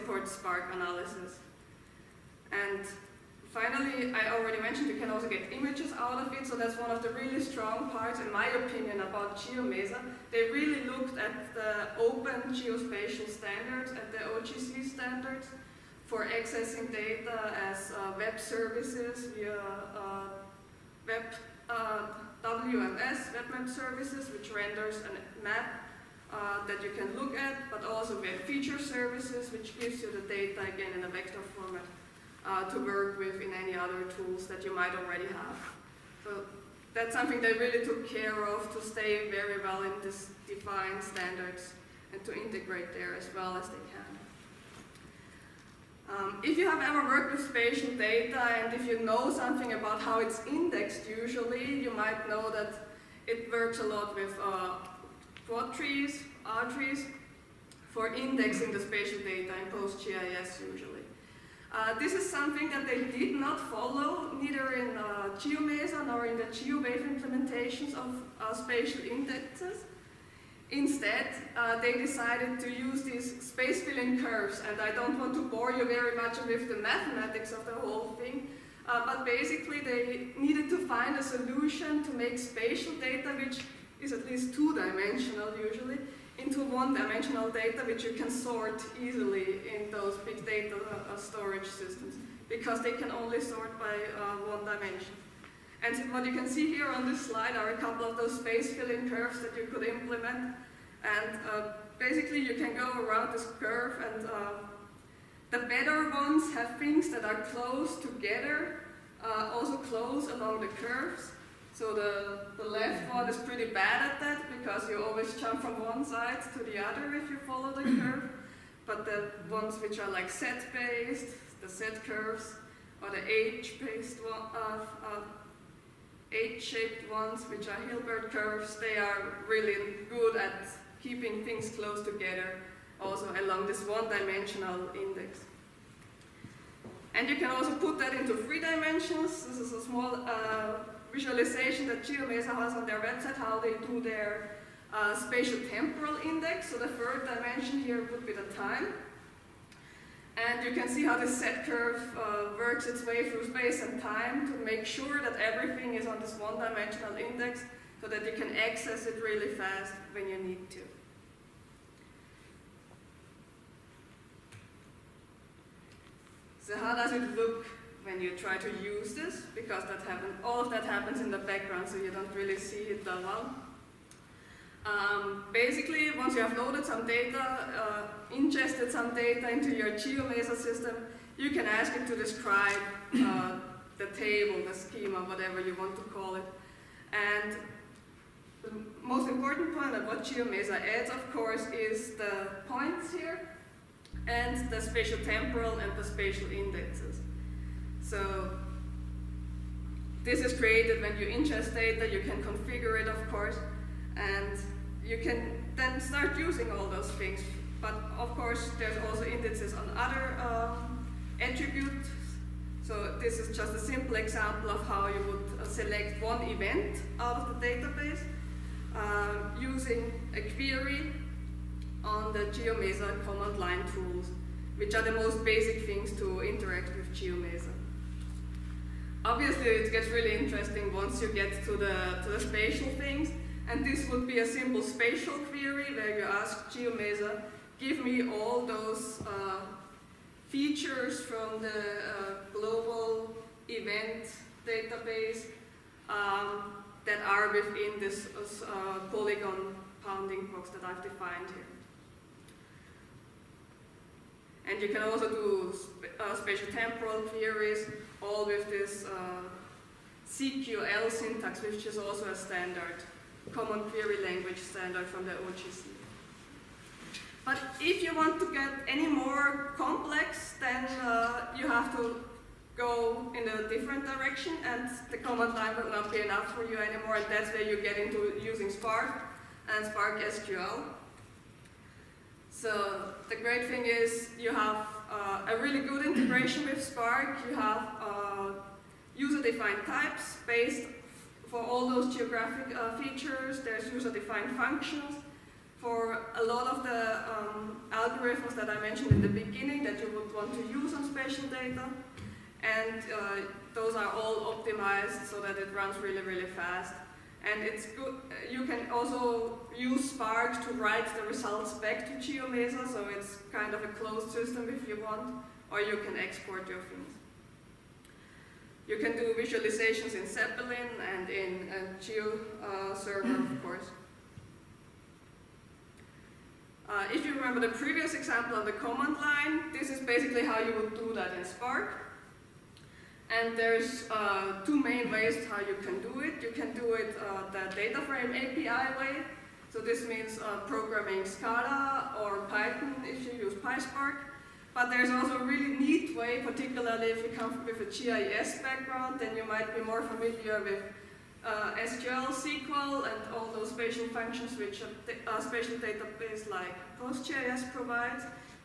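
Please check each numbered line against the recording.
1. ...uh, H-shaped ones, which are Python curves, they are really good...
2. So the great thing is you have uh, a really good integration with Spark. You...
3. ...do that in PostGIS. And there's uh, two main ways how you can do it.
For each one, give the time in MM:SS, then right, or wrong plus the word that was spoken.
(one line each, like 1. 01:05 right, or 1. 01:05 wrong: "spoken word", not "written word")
1. 02:05 wrong: "Hilbert", not "Python"
2. 04:42 right
3. 05:30 wrong: "Spark", not "PostGIS".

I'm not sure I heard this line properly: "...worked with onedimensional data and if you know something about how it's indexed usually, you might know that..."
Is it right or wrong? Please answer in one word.
wrong.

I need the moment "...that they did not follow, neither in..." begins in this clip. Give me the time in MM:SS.
01:02.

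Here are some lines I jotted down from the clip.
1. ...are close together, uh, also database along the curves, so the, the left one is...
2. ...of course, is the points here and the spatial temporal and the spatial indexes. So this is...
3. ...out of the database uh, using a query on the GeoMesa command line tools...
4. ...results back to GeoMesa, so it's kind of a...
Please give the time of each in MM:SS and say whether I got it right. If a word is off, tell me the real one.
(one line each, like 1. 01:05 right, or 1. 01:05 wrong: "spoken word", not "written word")
1. 01:47 wrong: "close", not "database"
2. 03:11 right
3. 03:37 right
4. 05:11 right.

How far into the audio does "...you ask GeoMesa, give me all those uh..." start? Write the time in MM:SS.
03:56.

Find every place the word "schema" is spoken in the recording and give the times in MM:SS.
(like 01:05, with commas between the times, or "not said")
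03:04.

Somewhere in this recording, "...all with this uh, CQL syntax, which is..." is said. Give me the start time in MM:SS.
04:18.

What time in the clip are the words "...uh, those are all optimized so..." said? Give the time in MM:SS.
05:03.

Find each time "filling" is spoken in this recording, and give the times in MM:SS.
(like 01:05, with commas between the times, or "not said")
01:13, 01:38.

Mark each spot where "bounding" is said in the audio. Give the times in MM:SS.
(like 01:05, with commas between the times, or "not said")
04:10.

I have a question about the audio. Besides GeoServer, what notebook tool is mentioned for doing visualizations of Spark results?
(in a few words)
Zeppelin.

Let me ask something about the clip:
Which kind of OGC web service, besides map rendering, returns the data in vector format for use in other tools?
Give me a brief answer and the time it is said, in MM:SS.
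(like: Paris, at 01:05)
web feature services, at 00:28.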